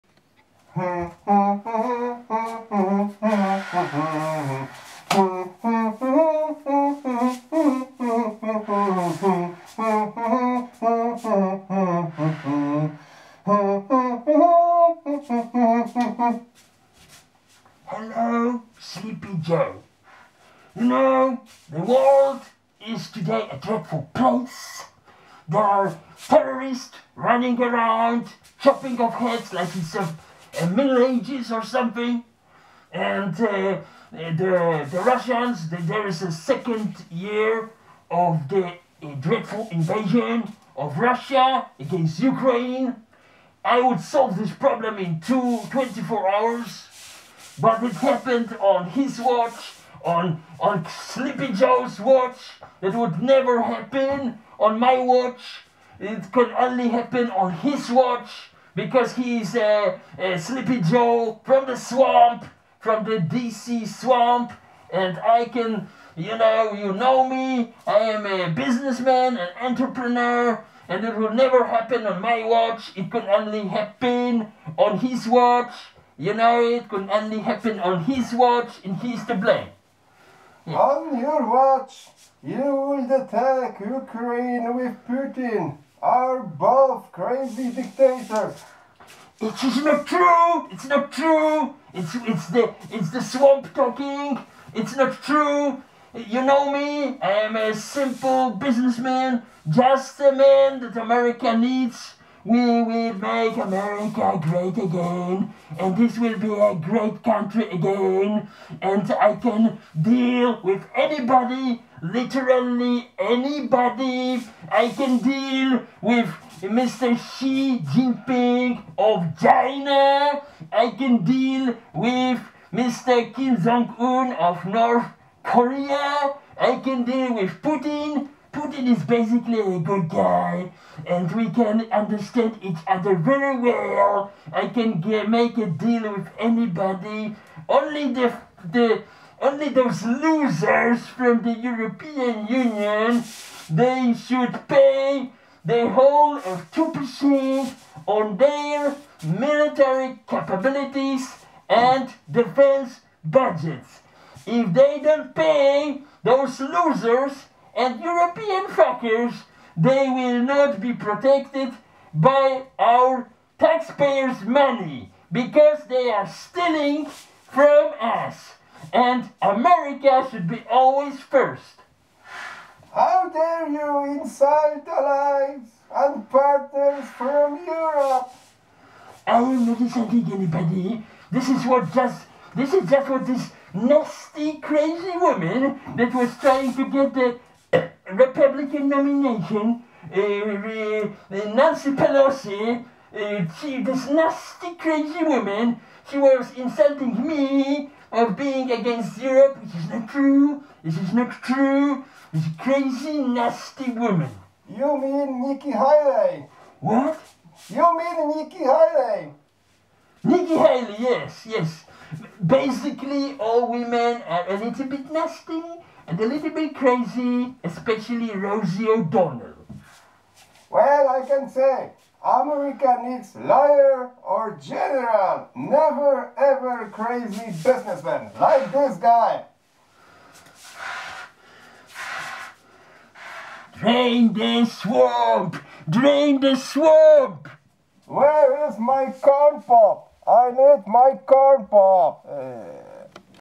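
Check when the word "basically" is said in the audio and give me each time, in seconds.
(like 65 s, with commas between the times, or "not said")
129 s, 212 s.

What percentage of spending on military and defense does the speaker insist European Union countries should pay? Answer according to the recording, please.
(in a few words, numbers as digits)
2 percent.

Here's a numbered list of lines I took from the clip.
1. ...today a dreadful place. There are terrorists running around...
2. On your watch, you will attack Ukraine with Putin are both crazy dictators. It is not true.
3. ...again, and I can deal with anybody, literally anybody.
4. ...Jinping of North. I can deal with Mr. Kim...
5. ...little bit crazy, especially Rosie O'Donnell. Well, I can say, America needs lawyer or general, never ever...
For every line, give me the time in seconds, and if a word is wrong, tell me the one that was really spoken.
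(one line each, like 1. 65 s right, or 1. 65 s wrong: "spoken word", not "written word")
1. 23 s right
2. 80 s right
3. 107 s right
4. 117 s wrong: "China", not "North"
5. 216 s right.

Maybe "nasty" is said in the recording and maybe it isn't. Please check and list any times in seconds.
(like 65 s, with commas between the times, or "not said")
183 s, 194 s, 203 s, 215 s.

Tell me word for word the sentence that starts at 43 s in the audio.
I would solve this problem in two, 24 hours, but it happened on his watch, on, on Sleepy Joe's watch.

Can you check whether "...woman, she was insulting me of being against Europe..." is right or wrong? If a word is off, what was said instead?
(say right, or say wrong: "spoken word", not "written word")
right.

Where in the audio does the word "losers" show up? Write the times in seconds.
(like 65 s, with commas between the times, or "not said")
140 s, 156 s.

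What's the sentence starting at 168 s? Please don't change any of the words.
And America should be always first.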